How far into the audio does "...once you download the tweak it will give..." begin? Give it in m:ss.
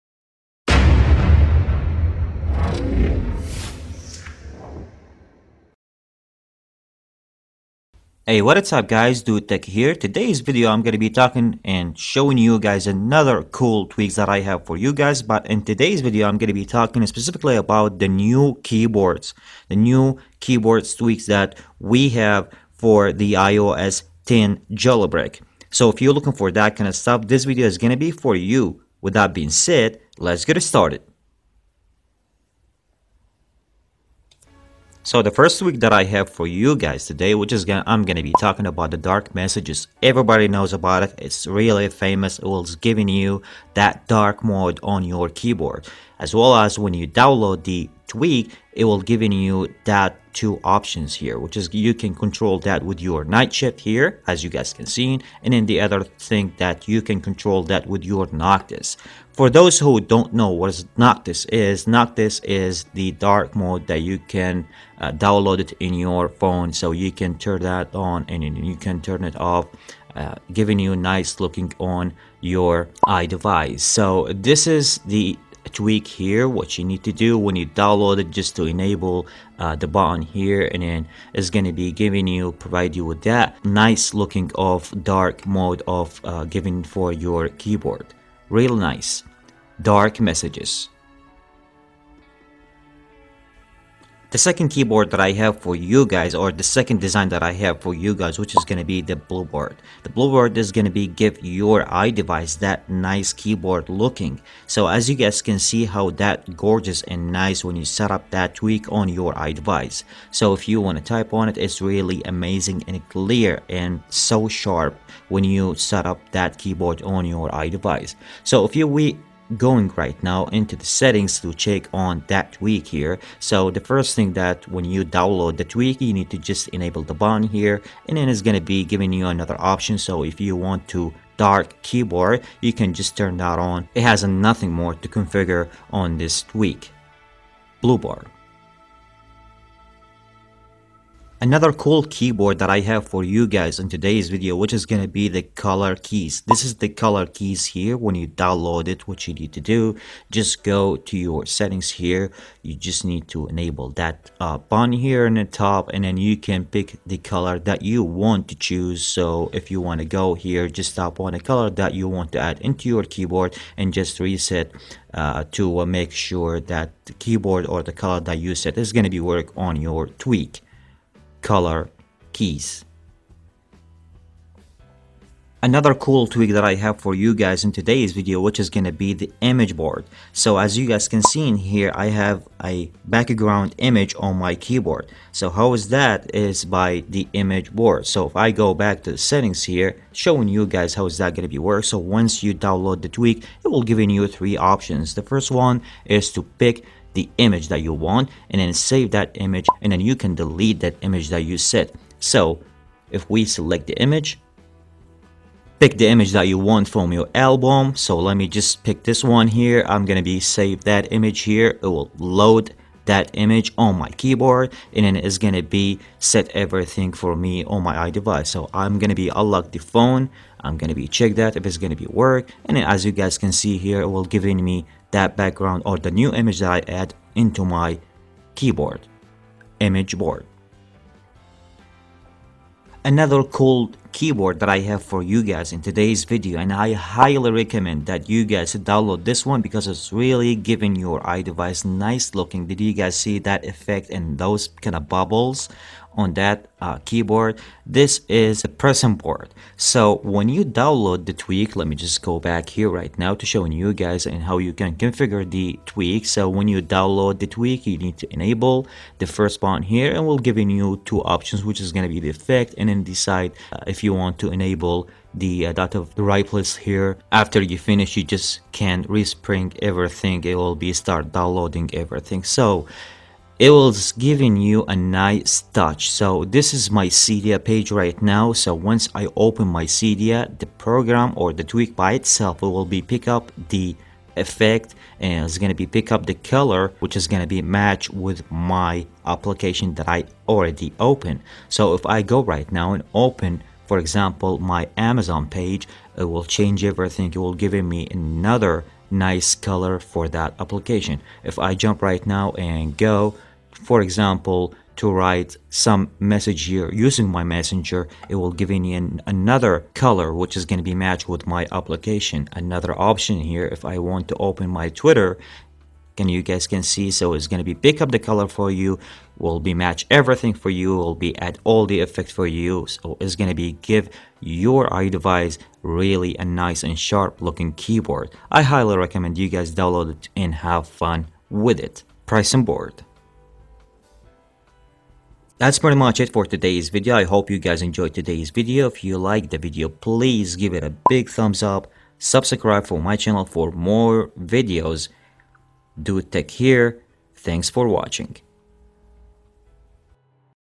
3:11.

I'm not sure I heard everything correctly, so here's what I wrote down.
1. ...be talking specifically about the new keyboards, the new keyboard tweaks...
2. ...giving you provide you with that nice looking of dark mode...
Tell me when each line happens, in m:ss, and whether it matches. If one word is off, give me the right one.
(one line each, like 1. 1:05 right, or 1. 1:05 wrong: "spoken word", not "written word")
1. 0:16 right
2. 1:21 right.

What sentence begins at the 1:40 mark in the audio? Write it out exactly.
The blueboard is going to be give your iDevice that nice keyboard looking.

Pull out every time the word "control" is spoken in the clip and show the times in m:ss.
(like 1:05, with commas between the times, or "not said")
0:52, 0:57.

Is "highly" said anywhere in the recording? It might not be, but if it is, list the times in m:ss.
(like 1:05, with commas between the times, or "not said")
3:56, 5:28.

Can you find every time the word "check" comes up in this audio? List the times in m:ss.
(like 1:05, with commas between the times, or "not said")
2:01, 3:41.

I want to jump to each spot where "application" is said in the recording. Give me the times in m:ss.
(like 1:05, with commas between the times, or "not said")
4:49, 5:00, 5:11.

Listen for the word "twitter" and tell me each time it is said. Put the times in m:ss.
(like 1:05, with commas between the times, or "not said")
5:15.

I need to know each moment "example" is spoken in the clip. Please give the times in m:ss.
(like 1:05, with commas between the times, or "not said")
4:53, 5:04.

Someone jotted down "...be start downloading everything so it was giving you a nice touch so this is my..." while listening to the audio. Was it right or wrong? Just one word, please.
right.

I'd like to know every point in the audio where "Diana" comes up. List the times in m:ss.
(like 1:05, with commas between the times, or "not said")
not said.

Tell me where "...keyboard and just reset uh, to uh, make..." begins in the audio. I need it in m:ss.
2:43.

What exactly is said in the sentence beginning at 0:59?
For those who don't know what Noctis is, Noctis is the dark mode that you can uh, download it in your phone.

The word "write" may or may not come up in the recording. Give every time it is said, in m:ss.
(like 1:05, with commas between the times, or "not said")
4:26, 5:05.